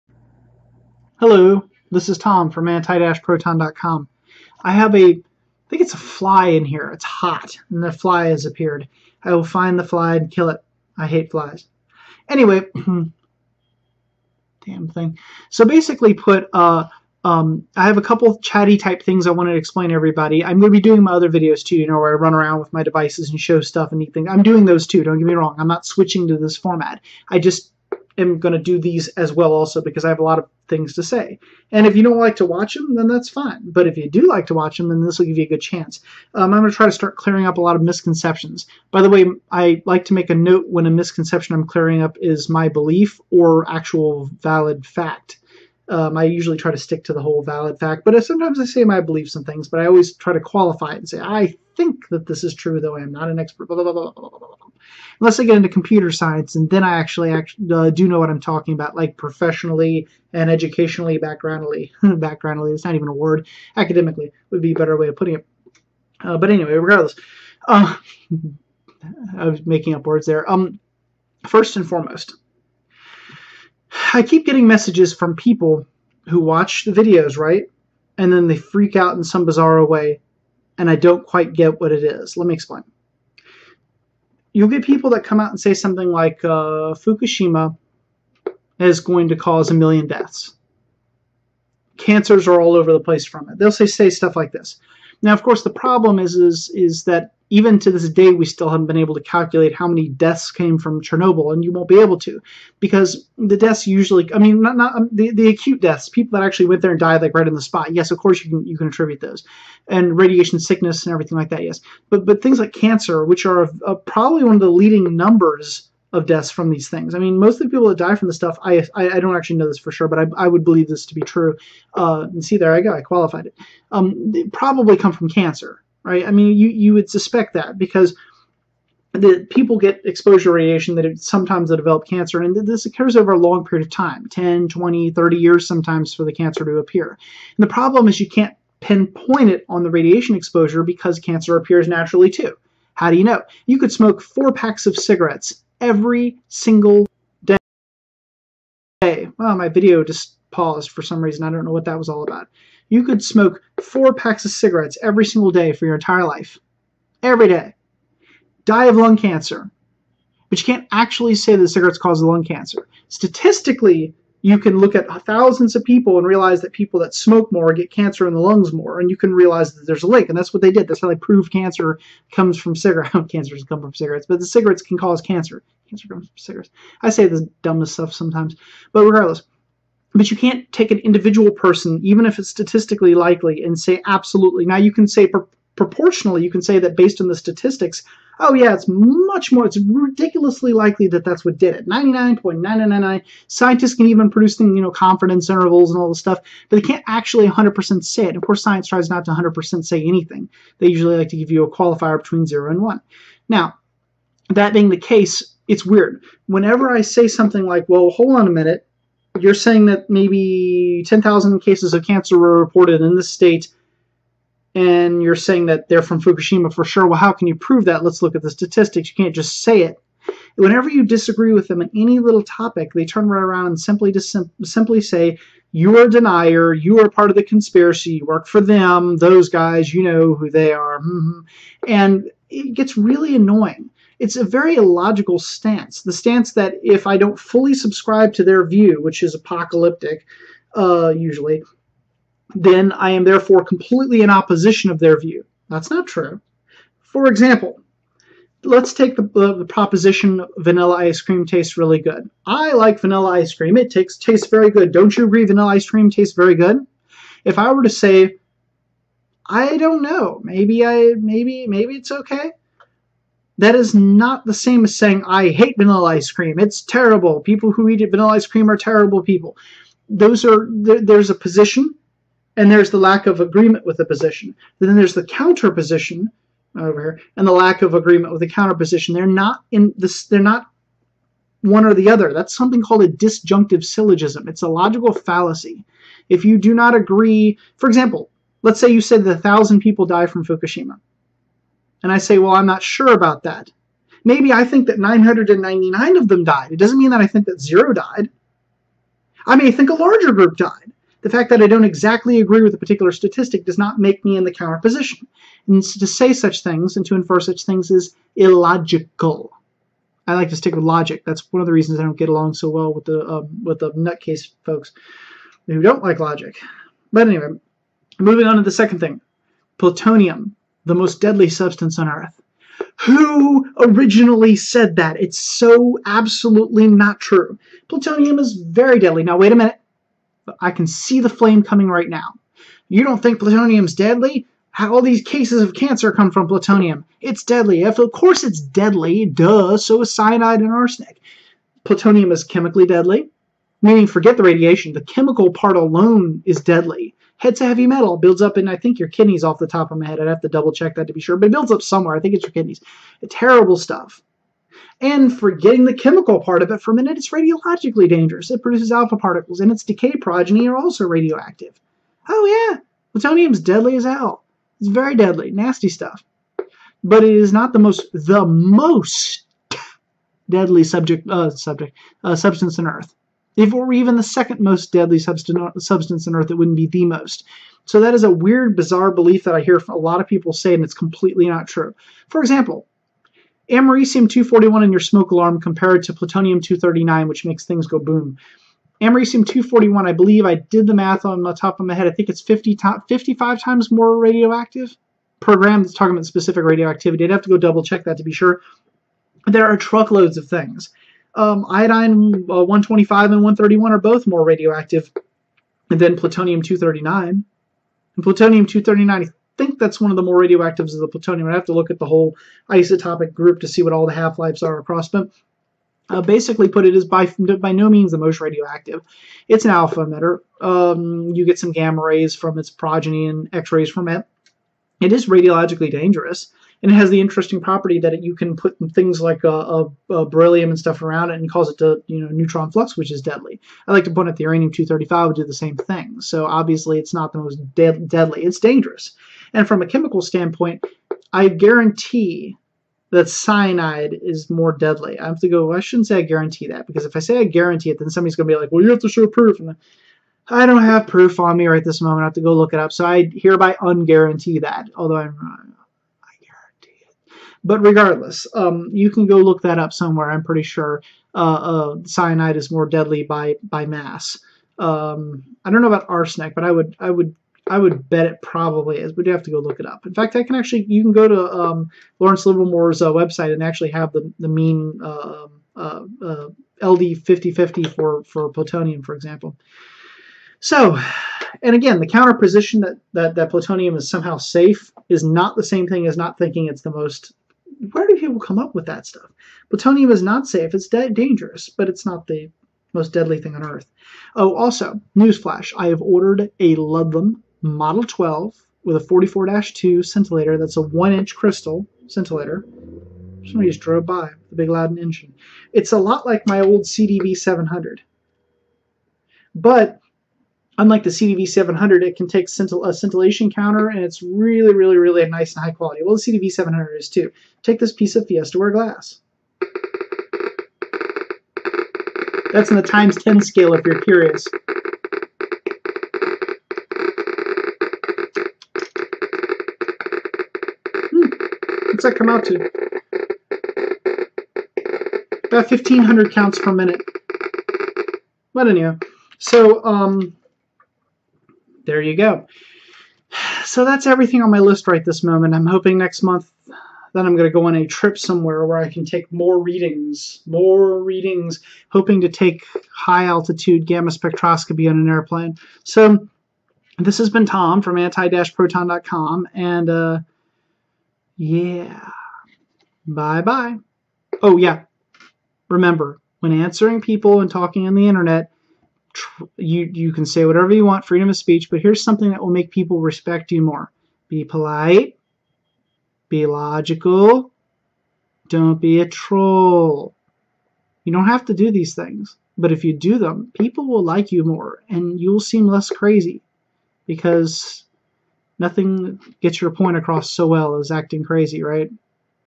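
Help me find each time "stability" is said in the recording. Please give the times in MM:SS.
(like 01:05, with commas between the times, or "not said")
not said.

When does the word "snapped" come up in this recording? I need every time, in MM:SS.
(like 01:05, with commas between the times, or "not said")
not said.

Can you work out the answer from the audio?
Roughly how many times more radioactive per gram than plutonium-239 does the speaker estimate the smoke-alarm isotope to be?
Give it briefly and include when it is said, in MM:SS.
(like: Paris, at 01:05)
50 to 55, at 06:32.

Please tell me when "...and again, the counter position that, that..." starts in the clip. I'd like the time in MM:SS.
08:01.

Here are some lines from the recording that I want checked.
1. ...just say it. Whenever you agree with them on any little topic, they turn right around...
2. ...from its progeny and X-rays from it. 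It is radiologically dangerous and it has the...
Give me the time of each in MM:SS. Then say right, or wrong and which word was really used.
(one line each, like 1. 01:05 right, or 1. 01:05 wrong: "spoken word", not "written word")
1. 03:39 wrong: "disagree", not "agree"
2. 07:02 right.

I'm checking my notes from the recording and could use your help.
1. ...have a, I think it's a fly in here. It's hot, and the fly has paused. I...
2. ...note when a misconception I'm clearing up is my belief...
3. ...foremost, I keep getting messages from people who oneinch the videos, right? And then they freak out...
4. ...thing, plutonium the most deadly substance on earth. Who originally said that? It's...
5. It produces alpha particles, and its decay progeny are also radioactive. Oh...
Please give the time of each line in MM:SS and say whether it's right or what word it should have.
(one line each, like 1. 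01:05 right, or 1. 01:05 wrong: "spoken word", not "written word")
1. 00:04 wrong: "appeared", not "paused"
2. 00:40 right
3. 01:11 wrong: "watch", not "oneinch"
4. 05:18 right
5. 05:58 right.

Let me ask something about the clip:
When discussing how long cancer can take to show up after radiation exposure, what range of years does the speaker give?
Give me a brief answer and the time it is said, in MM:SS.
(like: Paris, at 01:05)
10, 20, 30 years, at 02:14.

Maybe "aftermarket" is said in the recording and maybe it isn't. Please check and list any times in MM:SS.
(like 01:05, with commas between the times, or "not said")
not said.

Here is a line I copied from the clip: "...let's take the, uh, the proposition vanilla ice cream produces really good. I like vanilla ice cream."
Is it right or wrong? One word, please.
wrong.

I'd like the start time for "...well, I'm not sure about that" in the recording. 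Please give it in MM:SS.
04:52.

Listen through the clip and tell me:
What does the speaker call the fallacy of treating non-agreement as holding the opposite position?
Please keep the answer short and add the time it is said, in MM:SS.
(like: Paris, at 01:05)
Disjunctive syllogism, at 04:43.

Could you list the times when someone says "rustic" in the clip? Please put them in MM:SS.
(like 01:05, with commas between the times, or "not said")
not said.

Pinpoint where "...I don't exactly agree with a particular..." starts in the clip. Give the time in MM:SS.
05:01.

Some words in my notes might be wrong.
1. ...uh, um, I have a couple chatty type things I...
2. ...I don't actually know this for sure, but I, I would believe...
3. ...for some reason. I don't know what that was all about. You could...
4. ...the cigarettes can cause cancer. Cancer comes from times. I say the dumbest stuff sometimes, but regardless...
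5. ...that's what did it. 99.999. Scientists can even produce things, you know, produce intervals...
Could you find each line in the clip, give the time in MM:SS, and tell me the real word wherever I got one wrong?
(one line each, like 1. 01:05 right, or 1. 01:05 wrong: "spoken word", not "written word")
1. 00:16 right
2. 01:59 right
3. 02:30 right
4. 02:54 wrong: "cigarettes", not "times"
5. 03:11 wrong: "confidence", not "produce".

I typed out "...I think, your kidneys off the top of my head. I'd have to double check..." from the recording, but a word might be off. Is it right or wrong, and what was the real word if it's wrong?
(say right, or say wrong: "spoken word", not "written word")
right.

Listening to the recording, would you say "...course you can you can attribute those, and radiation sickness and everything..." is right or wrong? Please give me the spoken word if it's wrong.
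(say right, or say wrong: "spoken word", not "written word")
right.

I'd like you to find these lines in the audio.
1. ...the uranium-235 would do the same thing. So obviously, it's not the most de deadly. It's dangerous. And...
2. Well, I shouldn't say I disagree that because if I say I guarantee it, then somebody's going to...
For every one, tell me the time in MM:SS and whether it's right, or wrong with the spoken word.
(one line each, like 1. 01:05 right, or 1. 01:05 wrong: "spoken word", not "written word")
1. 07:14 right
2. 07:25 wrong: "guarantee", not "disagree".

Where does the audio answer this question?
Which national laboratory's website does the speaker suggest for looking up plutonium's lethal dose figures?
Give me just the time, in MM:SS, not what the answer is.
07:52.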